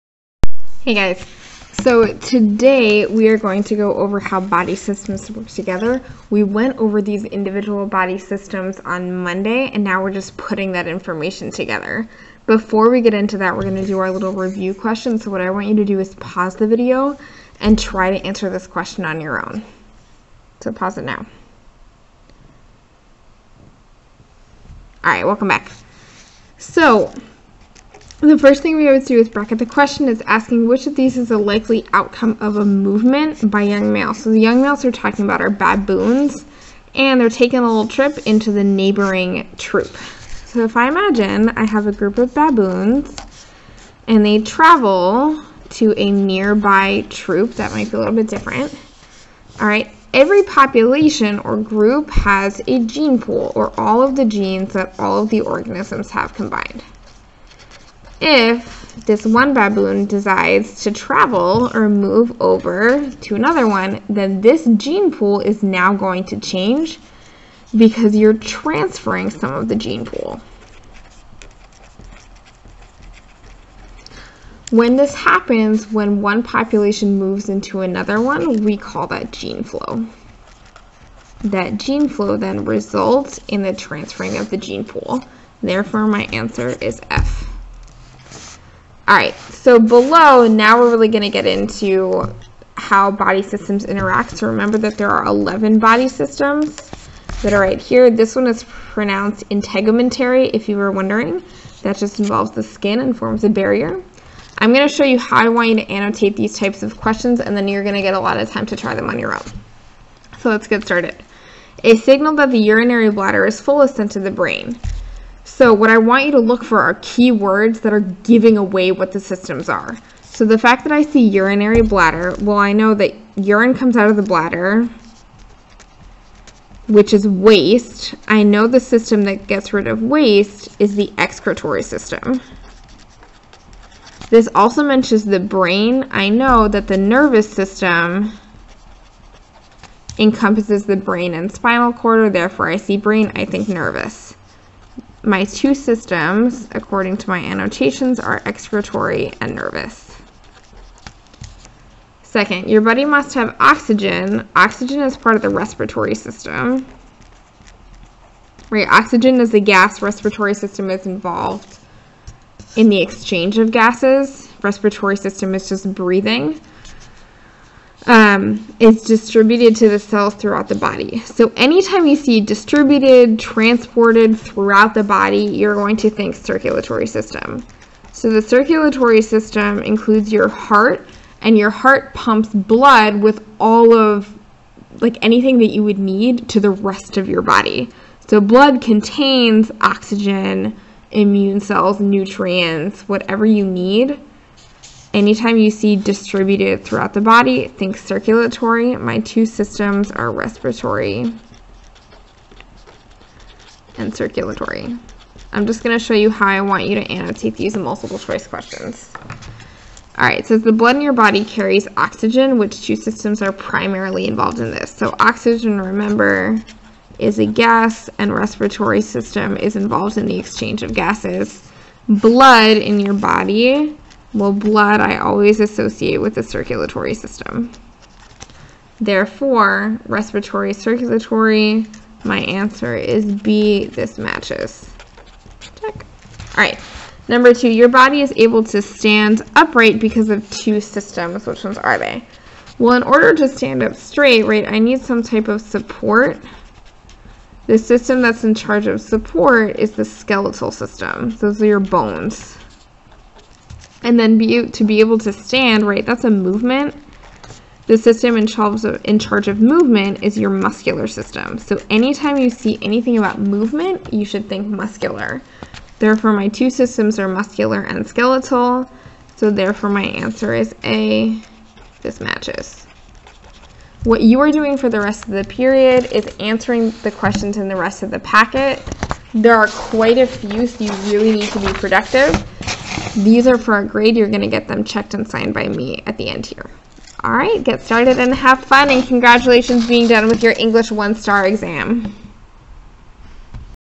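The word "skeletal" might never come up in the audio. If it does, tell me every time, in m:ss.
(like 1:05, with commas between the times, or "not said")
4:10, 4:28.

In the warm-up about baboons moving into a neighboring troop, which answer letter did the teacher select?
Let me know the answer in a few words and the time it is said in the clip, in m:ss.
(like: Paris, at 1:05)
F, at 1:26.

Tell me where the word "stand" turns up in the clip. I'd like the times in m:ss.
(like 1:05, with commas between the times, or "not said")
3:58, 4:03, 4:15.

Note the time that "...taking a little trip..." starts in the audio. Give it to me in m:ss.
0:37.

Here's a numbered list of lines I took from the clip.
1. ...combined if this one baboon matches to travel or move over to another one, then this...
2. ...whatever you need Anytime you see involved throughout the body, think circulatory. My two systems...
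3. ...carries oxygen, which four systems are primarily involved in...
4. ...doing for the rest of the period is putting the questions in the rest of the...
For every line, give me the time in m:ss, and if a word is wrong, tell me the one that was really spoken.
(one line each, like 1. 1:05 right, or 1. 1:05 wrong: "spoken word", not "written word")
1. 0:56 wrong: "decides", not "matches"
2. 3:13 wrong: "distributed", not "involved"
3. 3:31 wrong: "two", not "four"
4. 4:34 wrong: "answering", not "putting".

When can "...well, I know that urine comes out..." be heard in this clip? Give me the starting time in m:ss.
2:02.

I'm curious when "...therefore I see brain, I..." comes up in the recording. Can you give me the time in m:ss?
2:22.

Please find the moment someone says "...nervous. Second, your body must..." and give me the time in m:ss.
2:29.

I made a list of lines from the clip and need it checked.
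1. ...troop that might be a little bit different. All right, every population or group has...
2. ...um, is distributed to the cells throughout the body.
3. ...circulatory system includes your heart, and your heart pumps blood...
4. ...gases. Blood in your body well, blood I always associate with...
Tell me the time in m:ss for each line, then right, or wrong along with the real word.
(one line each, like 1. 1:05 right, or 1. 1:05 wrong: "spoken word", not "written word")
1. 0:47 right
2. 2:48 right
3. 2:58 right
4. 3:40 right.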